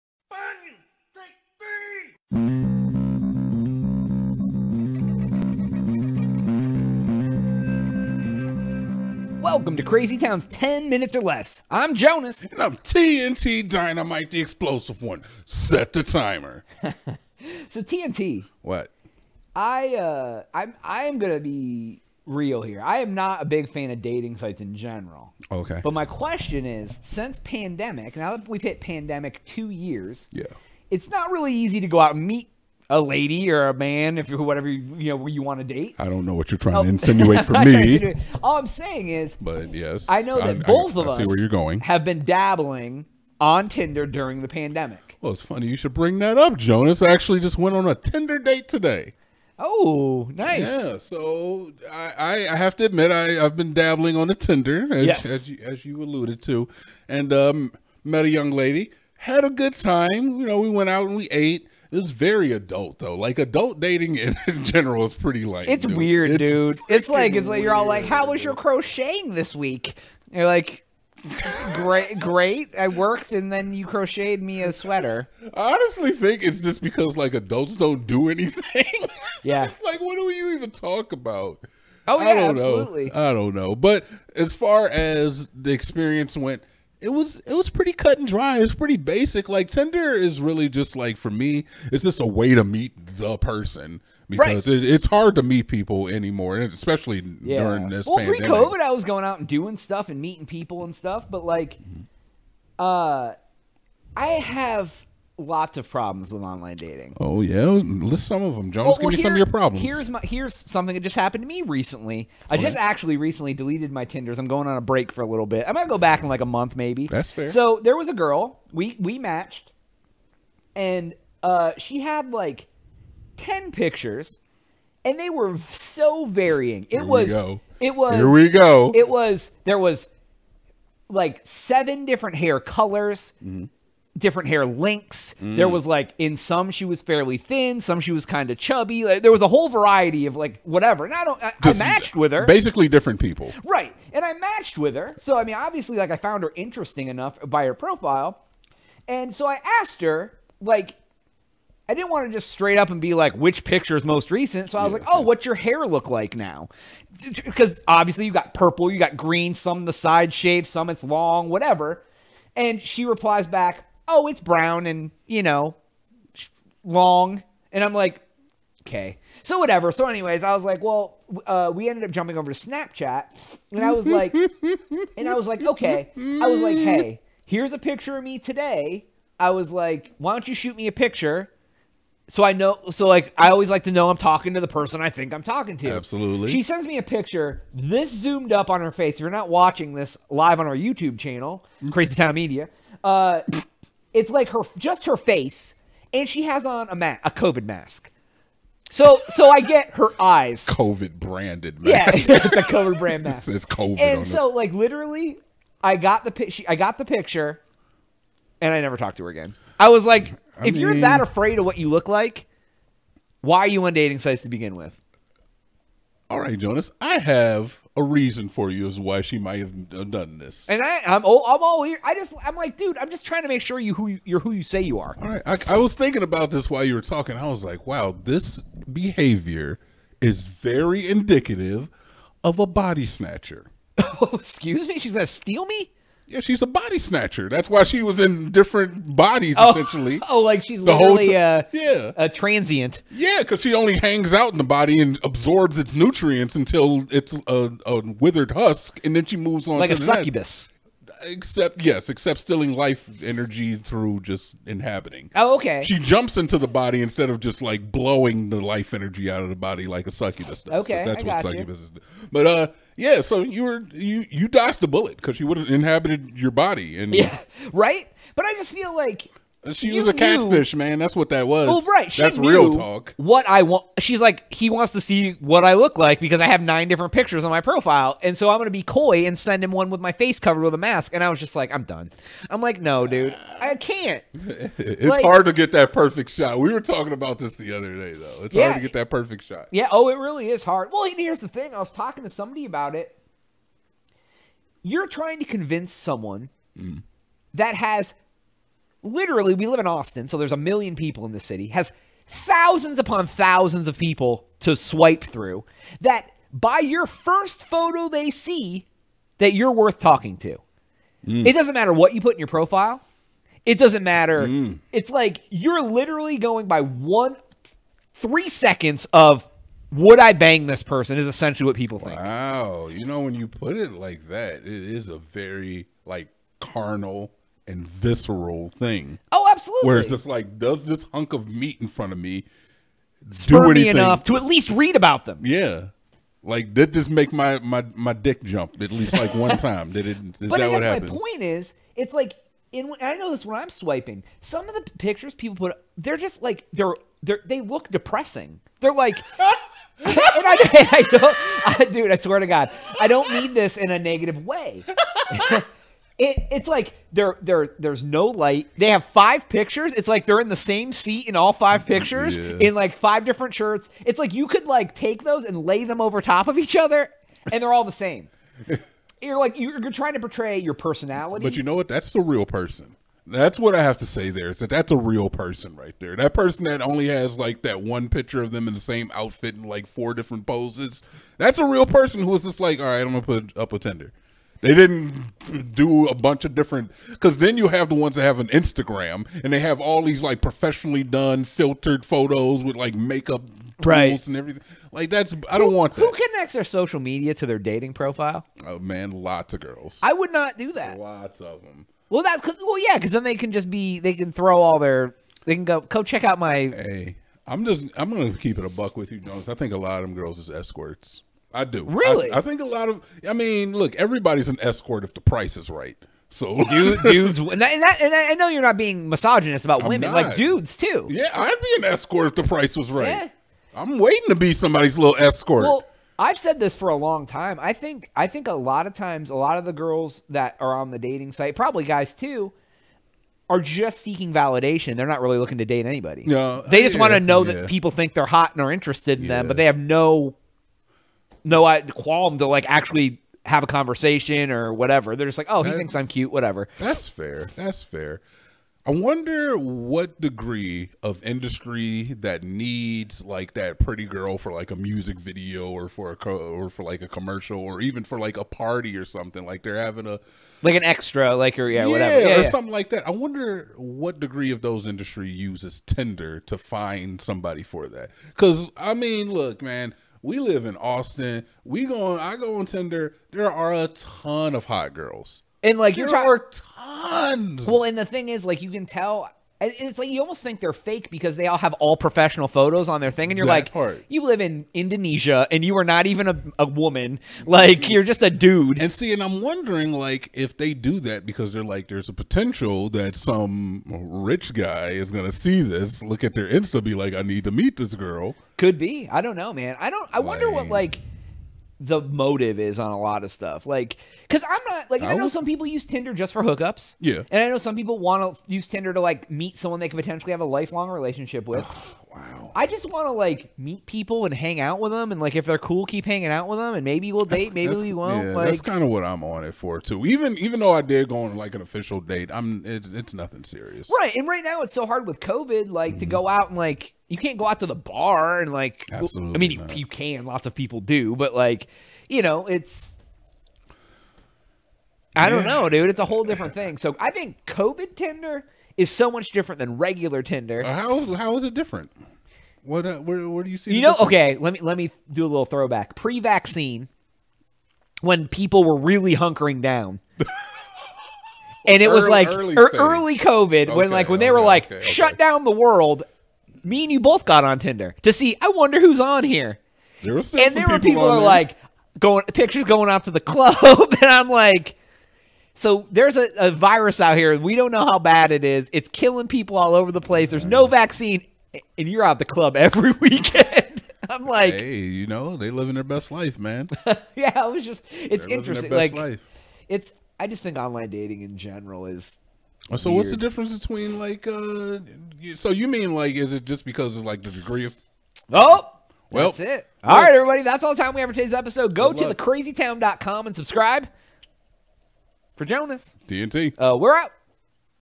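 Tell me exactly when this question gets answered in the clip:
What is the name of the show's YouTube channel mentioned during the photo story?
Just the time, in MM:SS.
03:11.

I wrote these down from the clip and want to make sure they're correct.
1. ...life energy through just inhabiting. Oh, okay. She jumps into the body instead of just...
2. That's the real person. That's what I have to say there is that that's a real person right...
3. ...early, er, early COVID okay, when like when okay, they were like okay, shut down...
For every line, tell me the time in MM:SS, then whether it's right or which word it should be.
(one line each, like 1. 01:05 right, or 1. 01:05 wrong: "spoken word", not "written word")
1. 04:12 right
2. 06:11 right
3. 09:12 right.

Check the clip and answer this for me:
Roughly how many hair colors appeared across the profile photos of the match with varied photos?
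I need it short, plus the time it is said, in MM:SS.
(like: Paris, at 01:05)
7, at 02:11.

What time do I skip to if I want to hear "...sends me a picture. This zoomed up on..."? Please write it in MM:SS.
03:06.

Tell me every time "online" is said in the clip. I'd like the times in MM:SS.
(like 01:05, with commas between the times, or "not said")
01:46, 09:40.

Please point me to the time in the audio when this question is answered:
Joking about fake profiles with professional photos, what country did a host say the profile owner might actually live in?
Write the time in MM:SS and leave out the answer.
08:04.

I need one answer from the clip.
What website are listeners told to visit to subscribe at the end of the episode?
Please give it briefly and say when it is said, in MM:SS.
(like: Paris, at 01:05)
thecrazytown.com, at 09:52.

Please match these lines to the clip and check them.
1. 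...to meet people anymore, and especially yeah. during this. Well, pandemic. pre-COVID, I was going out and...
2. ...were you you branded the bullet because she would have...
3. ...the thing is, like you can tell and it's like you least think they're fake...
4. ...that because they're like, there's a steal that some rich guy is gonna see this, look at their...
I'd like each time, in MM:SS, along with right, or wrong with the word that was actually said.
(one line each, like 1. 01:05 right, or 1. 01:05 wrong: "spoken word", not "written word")
1. 01:35 right
2. 04:23 wrong: "dodged", not "branded"
3. 07:57 wrong: "almost", not "least"
4. 08:11 wrong: "potential", not "steal".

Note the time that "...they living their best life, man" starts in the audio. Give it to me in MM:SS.
09:35.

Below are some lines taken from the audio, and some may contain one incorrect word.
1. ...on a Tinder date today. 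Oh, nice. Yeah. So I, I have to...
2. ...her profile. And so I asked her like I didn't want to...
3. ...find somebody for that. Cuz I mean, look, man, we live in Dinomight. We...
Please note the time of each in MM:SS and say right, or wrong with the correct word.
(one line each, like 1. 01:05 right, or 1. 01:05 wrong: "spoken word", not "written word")
1. 00:47 right
2. 02:27 right
3. 07:46 wrong: "Austin", not "Dinomight".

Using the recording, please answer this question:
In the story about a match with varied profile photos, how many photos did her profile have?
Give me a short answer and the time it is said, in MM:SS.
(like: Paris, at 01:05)
10, at 02:03.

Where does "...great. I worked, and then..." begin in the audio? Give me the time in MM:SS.
01:12.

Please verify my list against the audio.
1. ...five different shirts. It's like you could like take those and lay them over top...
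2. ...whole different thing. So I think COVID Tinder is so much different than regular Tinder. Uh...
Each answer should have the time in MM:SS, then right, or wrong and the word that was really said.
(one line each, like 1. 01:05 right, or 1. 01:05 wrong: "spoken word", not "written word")
1. 06:02 right
2. 08:56 right.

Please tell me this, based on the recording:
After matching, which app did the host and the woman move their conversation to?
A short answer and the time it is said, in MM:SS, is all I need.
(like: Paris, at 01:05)
Snapchat, at 02:52.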